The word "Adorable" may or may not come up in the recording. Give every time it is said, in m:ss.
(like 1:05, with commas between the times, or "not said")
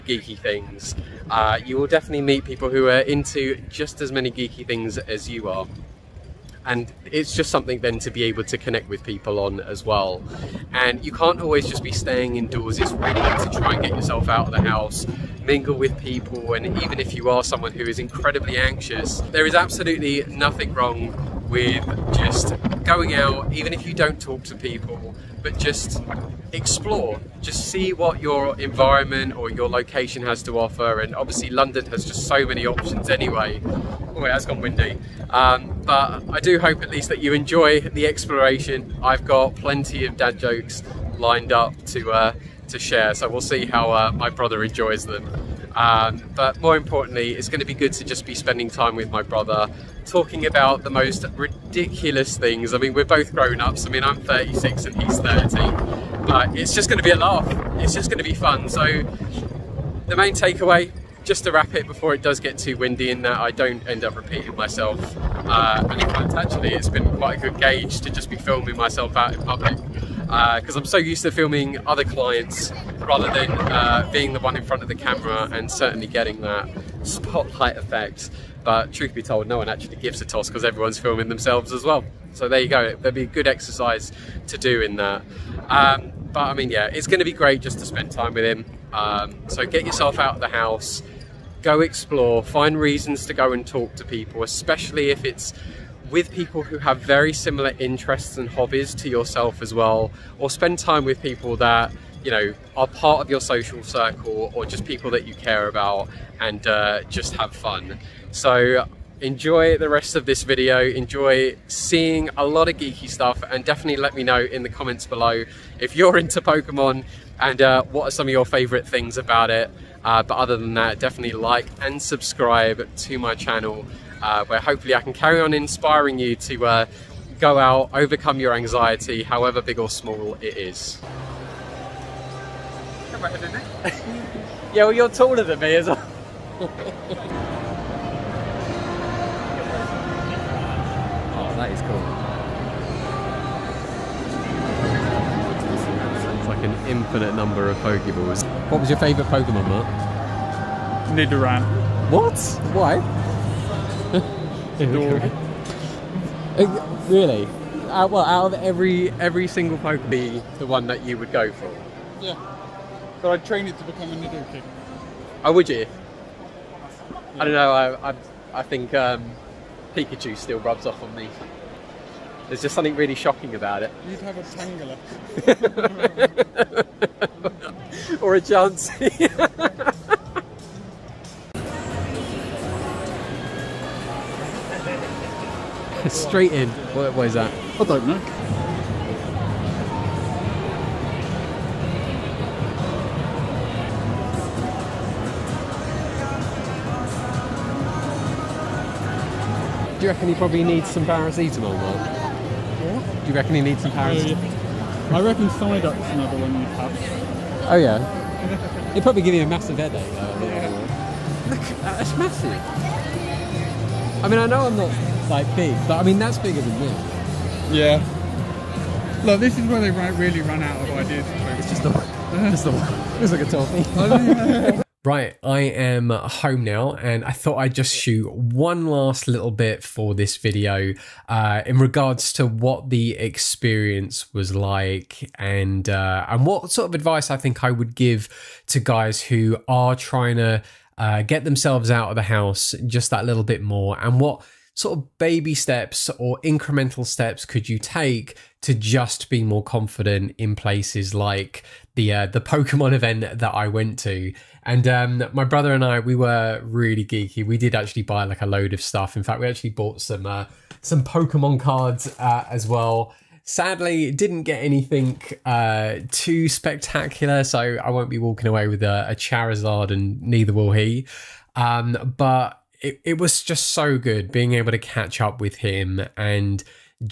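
2:34.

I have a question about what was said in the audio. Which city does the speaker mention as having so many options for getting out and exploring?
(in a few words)
London.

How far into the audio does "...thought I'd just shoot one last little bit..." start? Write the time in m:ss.
3:47.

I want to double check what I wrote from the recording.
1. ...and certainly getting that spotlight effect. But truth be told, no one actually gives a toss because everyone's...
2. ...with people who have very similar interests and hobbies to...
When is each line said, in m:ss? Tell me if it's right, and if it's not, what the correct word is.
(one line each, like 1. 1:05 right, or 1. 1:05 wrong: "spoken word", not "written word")
1. 1:15 right
2. 1:36 right.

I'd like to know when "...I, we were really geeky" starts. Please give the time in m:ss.
4:15.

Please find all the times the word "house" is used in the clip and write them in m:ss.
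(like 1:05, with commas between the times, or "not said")
0:14, 1:30, 4:02.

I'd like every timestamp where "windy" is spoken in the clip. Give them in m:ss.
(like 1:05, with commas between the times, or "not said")
0:34, 1:02.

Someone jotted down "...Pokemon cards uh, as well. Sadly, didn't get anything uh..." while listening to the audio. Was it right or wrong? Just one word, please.
right.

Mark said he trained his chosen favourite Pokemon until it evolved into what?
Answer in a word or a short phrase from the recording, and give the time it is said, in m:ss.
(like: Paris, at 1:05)
Nidoking, at 2:44.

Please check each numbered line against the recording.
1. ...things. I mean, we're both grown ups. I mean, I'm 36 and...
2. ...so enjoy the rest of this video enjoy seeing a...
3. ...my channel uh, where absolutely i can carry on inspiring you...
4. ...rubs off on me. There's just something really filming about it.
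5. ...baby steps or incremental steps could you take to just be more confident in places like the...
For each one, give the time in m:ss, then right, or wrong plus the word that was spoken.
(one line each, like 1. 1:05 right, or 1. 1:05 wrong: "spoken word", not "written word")
1. 0:52 right
2. 1:48 right
3. 2:03 wrong: "hopefully", not "absolutely"
4. 2:50 wrong: "shocking", not "filming"
5. 4:05 right.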